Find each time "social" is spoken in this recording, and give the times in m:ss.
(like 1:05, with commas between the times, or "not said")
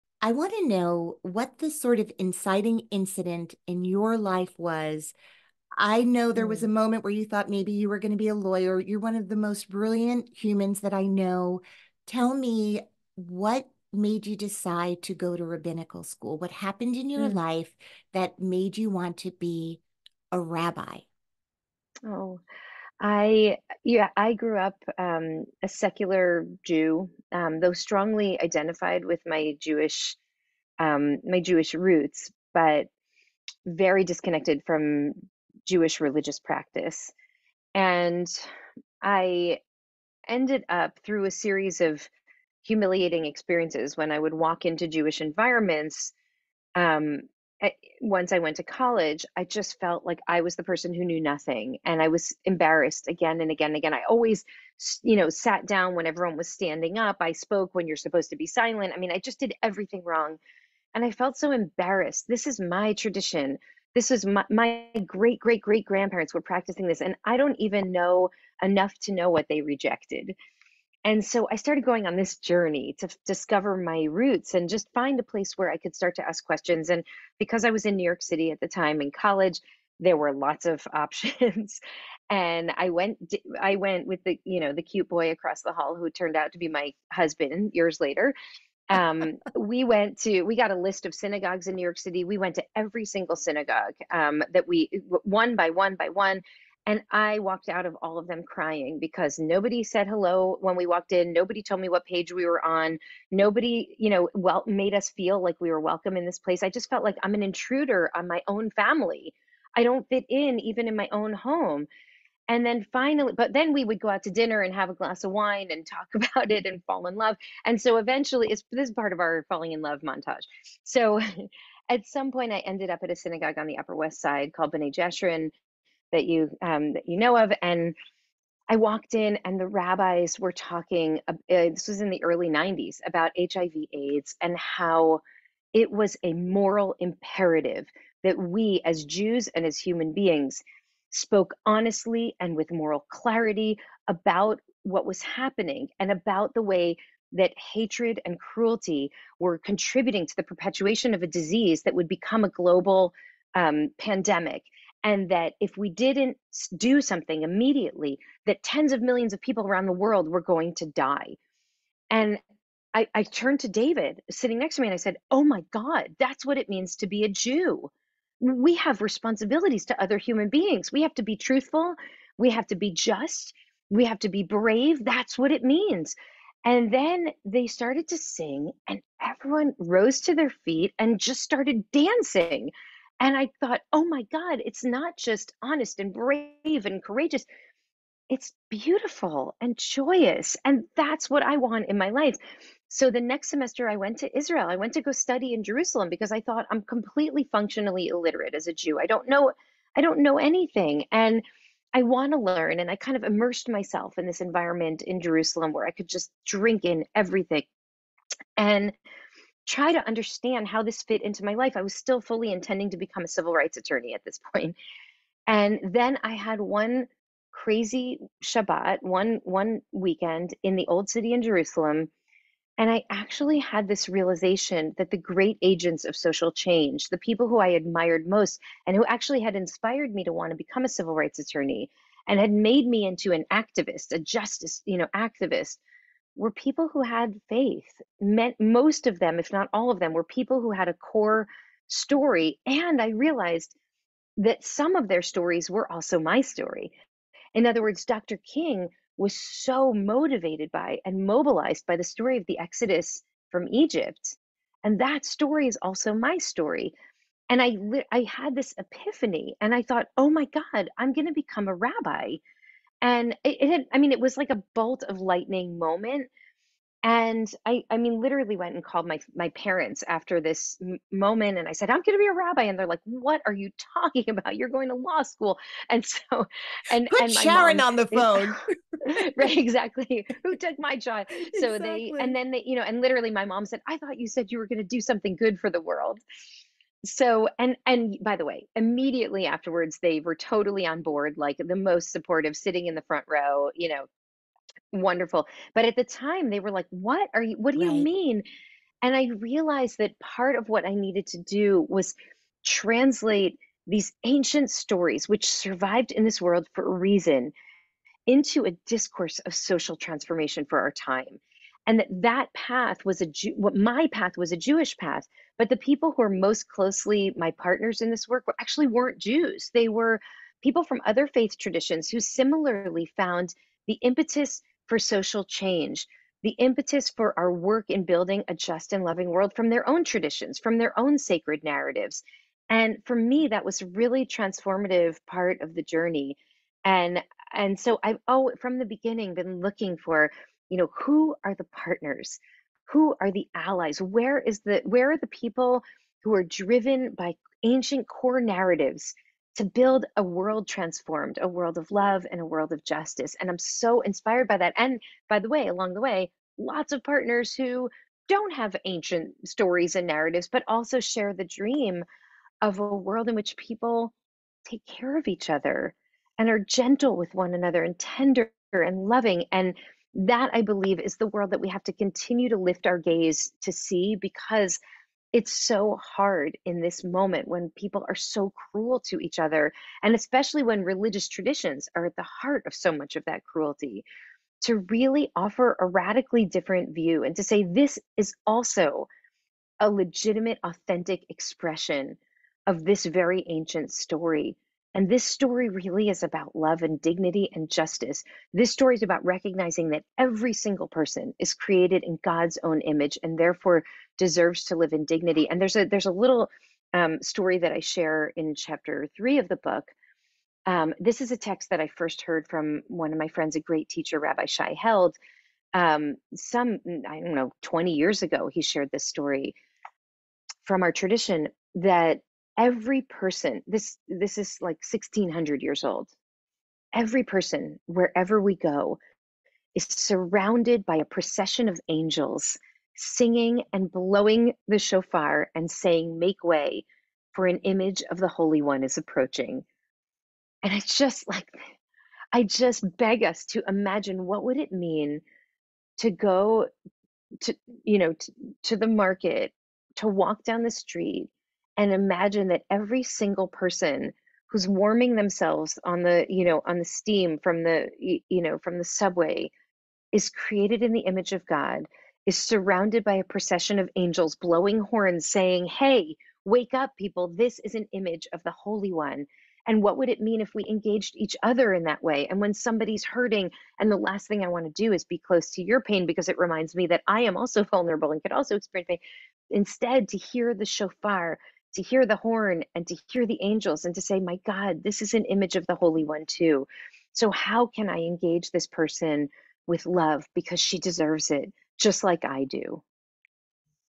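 3:46, 5:09, 5:24.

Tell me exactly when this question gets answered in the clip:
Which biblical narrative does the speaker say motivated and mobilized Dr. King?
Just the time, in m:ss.
4:12.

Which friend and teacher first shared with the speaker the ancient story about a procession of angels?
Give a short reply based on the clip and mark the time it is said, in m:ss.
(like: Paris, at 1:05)
Rabbi Shai Held, at 6:54.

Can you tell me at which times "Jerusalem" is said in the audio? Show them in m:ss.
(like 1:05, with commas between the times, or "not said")
3:15, 3:25, 3:41.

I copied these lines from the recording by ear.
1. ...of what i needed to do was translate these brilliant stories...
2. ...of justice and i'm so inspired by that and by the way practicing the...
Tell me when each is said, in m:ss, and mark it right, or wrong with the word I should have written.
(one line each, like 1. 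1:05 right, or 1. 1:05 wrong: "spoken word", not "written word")
1. 5:00 wrong: "ancient", not "brilliant"
2. 5:52 wrong: "along", not "practicing".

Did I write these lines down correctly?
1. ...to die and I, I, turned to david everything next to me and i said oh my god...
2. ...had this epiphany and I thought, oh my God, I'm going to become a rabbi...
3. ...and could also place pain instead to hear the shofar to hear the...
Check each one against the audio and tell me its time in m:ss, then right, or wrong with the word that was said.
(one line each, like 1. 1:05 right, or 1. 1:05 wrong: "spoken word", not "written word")
1. 2:40 wrong: "sitting", not "everything"
2. 4:18 right
3. 7:58 wrong: "experience", not "place".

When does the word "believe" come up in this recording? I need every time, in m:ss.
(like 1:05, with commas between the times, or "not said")
6:10.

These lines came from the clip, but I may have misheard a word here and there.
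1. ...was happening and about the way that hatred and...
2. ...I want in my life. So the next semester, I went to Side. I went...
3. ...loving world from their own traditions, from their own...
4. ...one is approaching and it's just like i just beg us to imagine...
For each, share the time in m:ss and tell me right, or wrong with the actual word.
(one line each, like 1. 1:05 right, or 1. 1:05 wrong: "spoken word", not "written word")
1. 2:25 right
2. 3:11 wrong: "Israel", not "Side"
3. 5:29 right
4. 7:18 right.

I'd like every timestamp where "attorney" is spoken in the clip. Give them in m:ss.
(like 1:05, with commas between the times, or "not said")
3:33, 3:51.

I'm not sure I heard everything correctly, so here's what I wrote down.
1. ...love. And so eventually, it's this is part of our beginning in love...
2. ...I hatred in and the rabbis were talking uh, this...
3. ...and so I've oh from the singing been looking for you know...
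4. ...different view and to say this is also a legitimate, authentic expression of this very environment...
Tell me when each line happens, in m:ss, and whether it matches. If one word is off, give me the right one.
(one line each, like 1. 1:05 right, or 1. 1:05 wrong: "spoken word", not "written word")
1. 1:57 wrong: "falling", not "beginning"
2. 2:08 wrong: "walked", not "hatred"
3. 5:37 wrong: "beginning", not "singing"
4. 6:26 wrong: "ancient", not "environment".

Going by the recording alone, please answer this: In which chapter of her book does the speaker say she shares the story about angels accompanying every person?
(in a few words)
3.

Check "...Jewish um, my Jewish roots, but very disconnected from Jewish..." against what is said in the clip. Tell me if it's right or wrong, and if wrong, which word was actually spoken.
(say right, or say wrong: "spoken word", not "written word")
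right.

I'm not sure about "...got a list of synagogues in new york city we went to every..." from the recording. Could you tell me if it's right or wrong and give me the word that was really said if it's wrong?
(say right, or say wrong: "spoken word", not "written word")
right.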